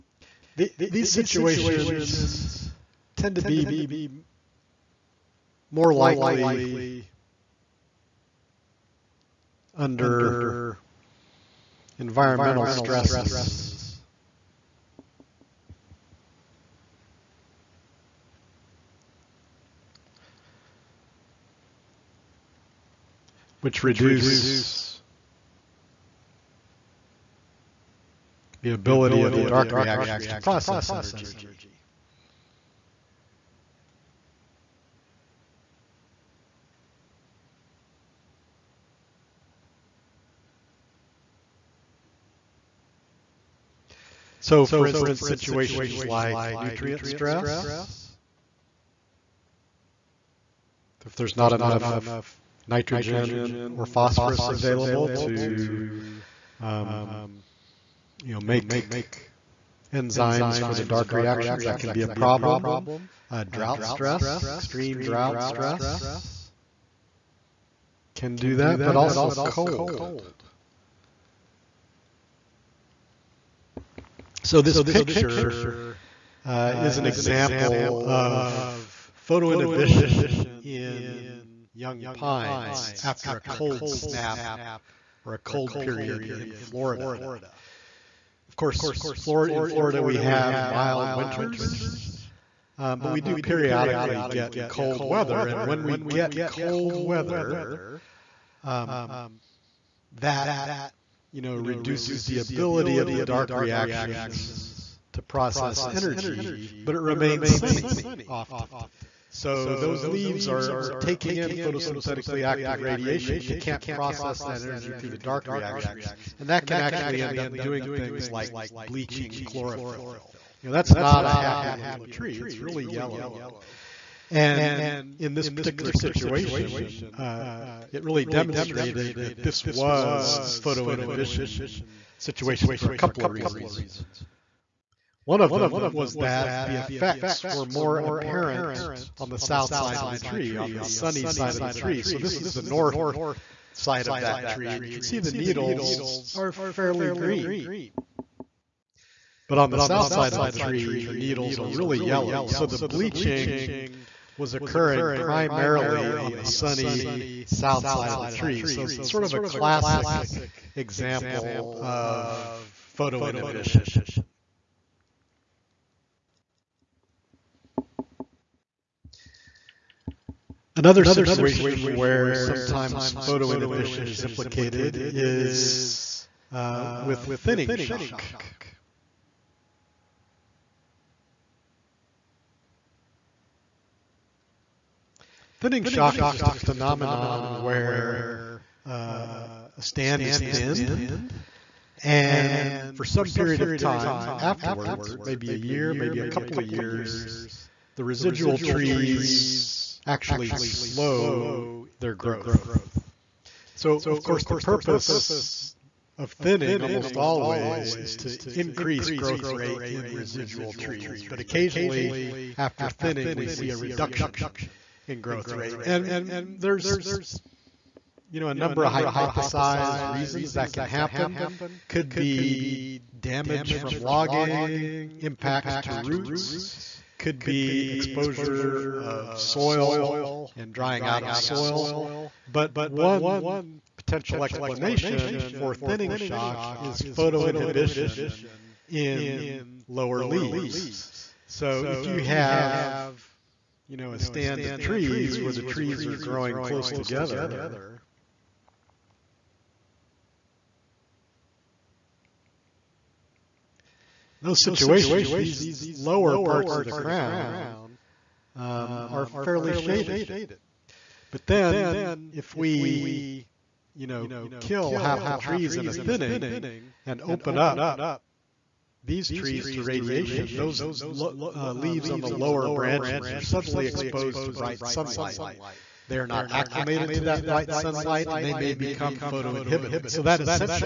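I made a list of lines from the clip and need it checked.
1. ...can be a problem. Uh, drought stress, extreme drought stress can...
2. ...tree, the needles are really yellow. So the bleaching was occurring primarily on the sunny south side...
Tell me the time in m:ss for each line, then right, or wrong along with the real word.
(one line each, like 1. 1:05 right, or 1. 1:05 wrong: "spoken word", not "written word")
1. 1:01 right
2. 2:30 right.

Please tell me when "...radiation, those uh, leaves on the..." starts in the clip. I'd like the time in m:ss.
4:29.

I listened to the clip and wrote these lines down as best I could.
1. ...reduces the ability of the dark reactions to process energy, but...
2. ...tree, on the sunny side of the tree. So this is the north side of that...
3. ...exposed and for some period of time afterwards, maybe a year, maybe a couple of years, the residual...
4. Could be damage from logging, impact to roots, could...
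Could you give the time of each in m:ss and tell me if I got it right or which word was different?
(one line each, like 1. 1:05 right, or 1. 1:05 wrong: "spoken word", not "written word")
1. 1:41 right
2. 2:20 right
3. 3:10 wrong: "thinned", not "exposed"
4. 3:41 right.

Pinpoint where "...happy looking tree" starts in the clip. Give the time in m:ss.
2:01.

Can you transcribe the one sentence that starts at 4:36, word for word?
They are not acclimated to that bright sunlight and they may become photoinhibited.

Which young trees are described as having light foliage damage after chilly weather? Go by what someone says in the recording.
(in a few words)
pines.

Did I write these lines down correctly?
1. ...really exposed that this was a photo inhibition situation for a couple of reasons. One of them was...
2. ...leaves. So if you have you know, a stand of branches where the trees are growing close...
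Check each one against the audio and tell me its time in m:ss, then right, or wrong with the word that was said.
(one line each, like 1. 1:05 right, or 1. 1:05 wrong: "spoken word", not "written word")
1. 2:08 wrong: "demonstrated", not "exposed"
2. 4:00 wrong: "trees", not "branches".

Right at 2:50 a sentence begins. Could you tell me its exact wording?
Another situation where sometimes photo inhibition is implicated is uh, with thinning shock.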